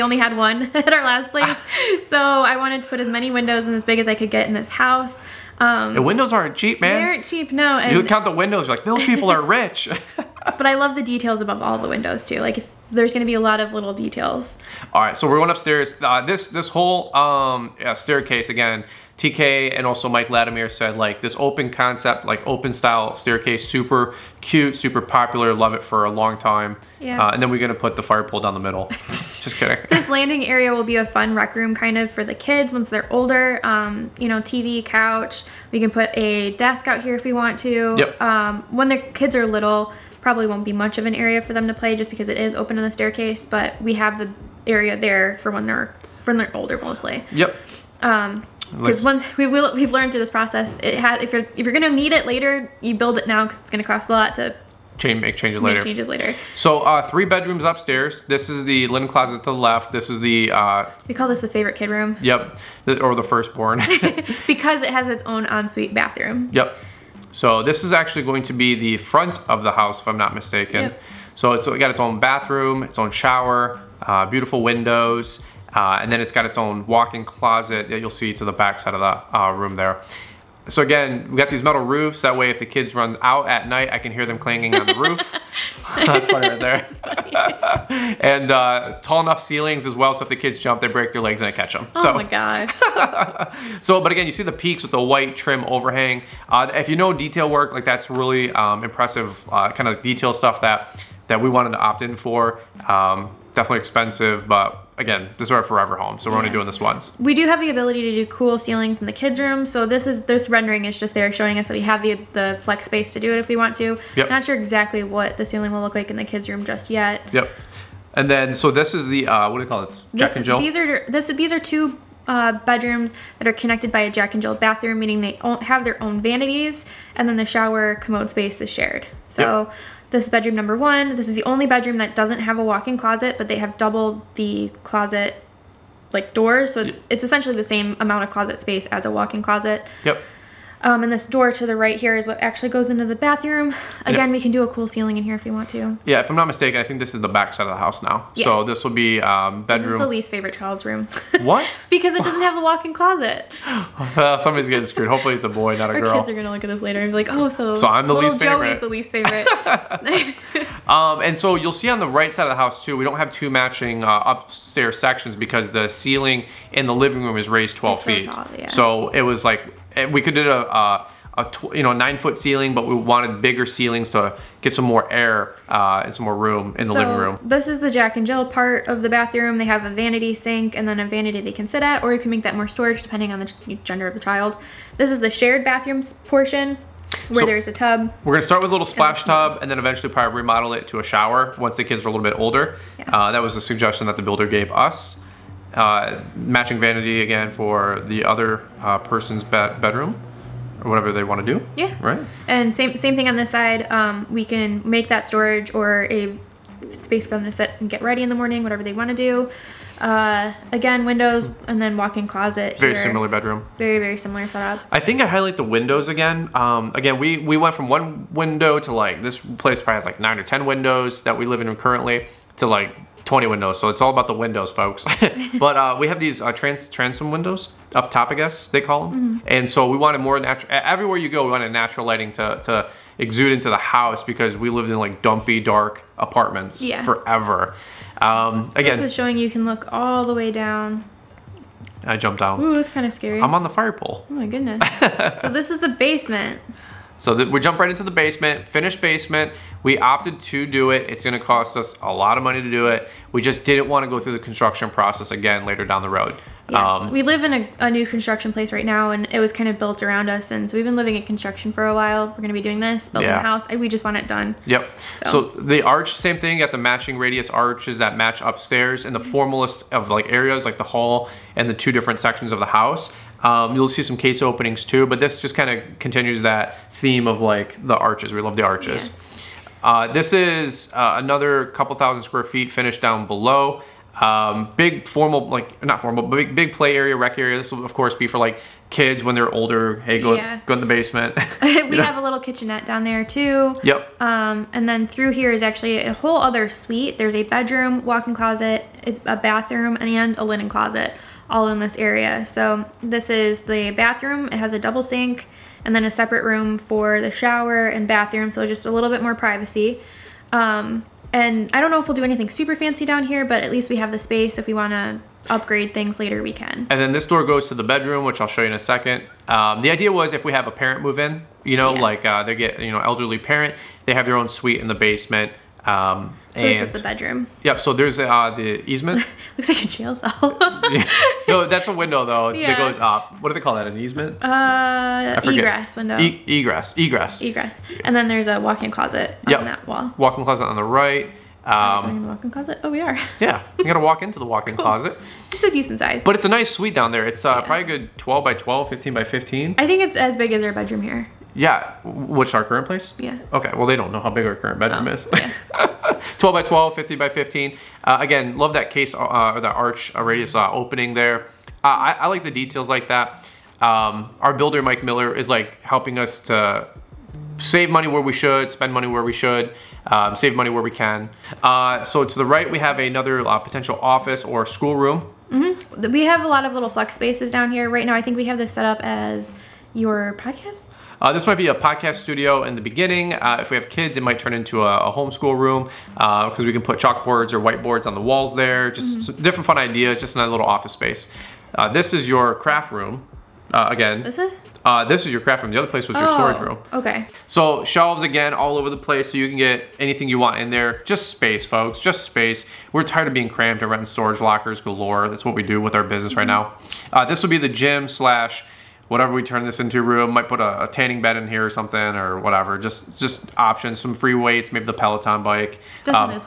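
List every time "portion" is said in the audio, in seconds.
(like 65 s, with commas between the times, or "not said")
186 s.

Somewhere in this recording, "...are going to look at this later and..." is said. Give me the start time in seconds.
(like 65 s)
156 s.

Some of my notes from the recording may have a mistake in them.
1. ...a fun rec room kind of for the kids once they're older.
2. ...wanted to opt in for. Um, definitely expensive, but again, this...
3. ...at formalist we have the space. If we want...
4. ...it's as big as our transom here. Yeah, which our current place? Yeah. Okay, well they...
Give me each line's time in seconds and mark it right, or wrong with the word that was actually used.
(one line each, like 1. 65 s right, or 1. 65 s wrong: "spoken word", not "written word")
1. 30 s right
2. 101 s right
3. 313 s wrong: "least", not "formalist"
4. 350 s wrong: "bedroom", not "transom".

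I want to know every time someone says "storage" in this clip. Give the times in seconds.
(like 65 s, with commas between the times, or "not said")
182 s, 205 s, 396 s, 404 s.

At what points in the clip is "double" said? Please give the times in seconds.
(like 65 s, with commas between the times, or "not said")
133 s, 304 s.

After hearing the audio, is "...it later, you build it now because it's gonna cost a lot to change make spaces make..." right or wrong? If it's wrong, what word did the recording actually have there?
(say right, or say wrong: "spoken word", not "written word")
wrong: "changes", not "spaces".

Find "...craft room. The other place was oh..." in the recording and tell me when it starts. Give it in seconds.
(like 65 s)
395 s.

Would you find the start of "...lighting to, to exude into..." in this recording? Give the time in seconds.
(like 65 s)
232 s.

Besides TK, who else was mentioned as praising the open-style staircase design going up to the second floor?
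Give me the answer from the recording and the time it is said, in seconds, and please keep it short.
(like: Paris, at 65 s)
Mike Latimer, at 20 s.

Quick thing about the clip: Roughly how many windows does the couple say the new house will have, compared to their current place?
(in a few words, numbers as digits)
20.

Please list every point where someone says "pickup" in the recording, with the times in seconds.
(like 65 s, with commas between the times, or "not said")
not said.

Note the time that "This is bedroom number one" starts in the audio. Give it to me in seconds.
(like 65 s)
130 s.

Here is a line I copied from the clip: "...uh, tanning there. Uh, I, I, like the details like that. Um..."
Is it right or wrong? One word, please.
wrong.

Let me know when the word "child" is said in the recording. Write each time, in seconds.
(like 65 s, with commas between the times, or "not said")
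150 s, 184 s.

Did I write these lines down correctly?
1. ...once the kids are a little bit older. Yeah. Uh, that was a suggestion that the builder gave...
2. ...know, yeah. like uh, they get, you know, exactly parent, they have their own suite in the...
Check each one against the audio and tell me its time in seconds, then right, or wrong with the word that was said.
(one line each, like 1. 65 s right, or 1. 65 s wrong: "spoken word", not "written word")
1. 191 s right
2. 321 s wrong: "elderly", not "exactly".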